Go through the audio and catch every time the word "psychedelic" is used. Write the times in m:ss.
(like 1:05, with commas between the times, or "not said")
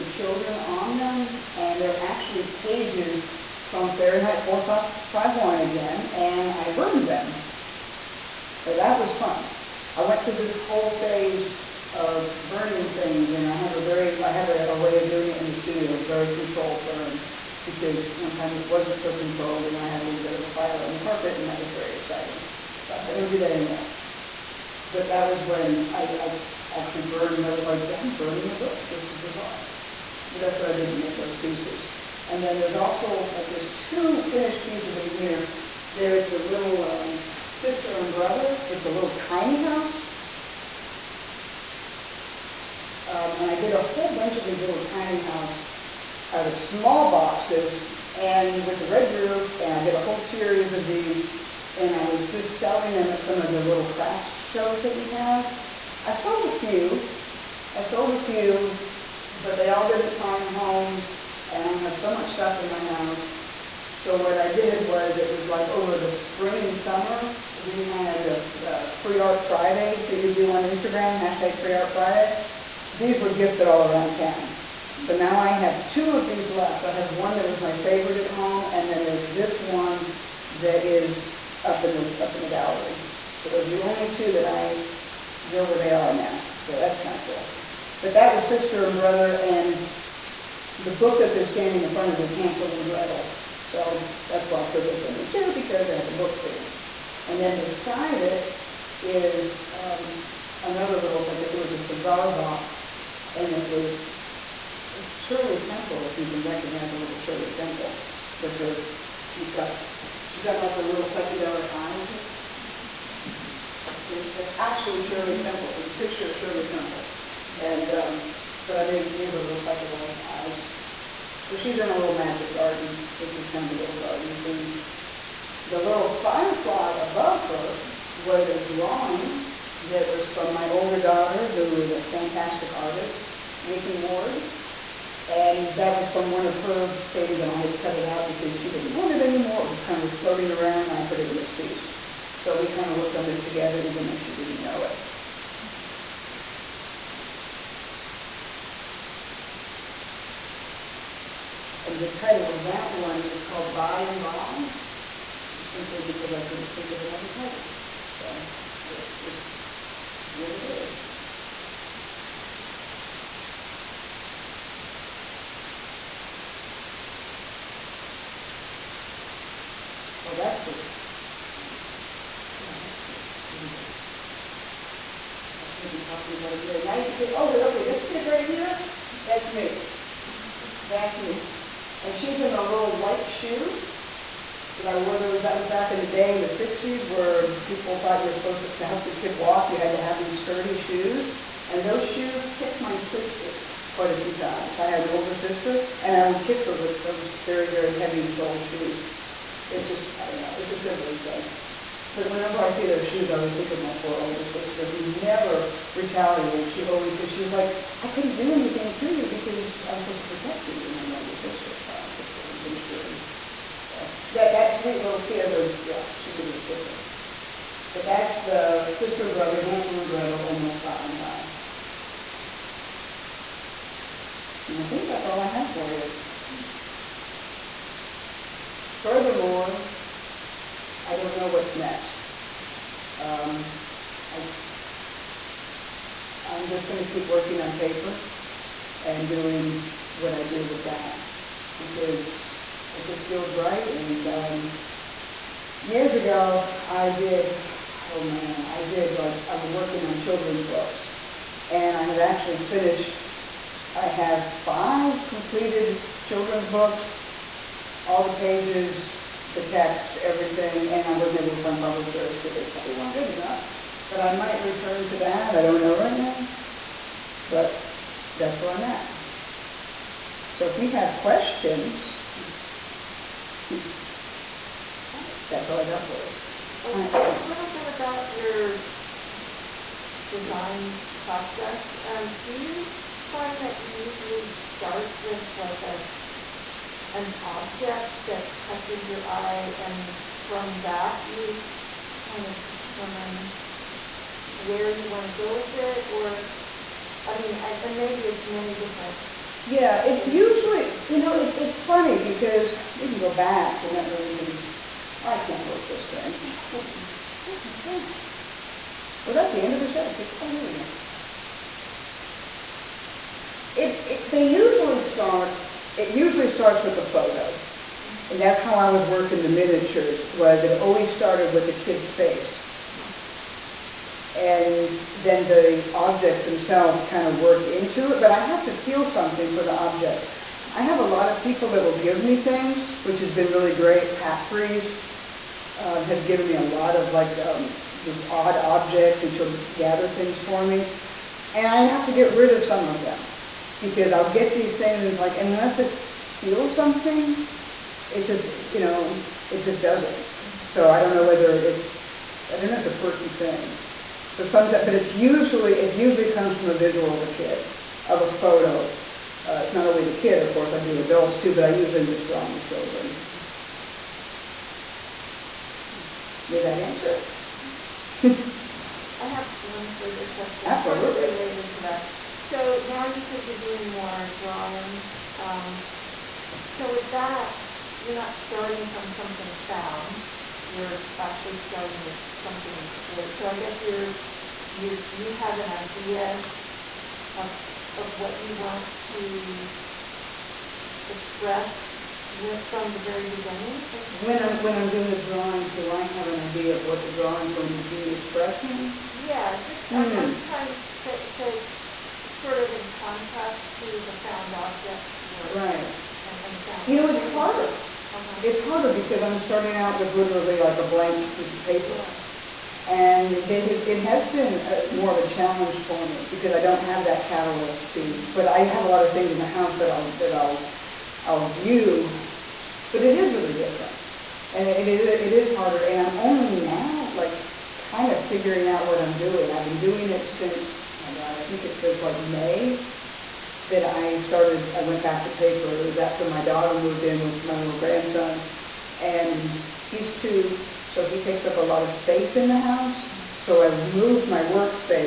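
1:51, 1:59.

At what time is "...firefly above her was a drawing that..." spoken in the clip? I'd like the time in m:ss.
2:06.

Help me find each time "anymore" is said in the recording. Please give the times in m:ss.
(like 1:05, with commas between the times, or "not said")
0:23, 2:19.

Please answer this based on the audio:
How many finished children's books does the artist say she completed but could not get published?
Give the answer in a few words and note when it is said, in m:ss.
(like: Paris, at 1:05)
5, at 4:14.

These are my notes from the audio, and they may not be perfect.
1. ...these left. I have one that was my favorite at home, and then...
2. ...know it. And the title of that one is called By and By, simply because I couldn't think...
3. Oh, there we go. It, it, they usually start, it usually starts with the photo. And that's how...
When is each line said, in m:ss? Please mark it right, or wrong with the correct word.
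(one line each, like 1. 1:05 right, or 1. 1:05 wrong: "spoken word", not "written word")
1. 1:16 right
2. 2:24 right
3. 5:10 right.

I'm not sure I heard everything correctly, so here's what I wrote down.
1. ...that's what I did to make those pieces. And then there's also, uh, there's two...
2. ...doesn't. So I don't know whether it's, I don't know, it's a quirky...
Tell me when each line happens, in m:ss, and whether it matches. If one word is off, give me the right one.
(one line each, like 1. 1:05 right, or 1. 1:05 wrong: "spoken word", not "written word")
1. 0:30 right
2. 5:49 right.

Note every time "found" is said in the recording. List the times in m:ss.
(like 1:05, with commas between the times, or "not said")
6:19, 6:44.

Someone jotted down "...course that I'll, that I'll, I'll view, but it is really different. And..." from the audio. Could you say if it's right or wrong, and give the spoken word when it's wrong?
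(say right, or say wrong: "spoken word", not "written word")
wrong: "house", not "course".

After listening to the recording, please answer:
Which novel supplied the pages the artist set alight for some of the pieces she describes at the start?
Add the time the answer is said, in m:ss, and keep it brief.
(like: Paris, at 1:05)
Fahrenheit 451, at 0:03.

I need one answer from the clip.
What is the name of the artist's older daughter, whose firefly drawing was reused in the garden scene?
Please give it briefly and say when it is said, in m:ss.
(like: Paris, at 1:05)
Nikki Ward, at 2:13.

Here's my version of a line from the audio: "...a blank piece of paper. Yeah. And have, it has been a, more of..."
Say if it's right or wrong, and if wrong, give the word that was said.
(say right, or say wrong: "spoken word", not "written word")
right.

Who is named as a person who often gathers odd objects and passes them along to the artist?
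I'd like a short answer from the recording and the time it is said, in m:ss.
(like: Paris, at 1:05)
Pat Priest, at 5:34.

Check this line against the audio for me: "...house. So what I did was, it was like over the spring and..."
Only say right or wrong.
right.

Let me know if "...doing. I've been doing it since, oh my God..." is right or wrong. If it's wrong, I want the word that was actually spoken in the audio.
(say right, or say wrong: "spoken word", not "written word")
right.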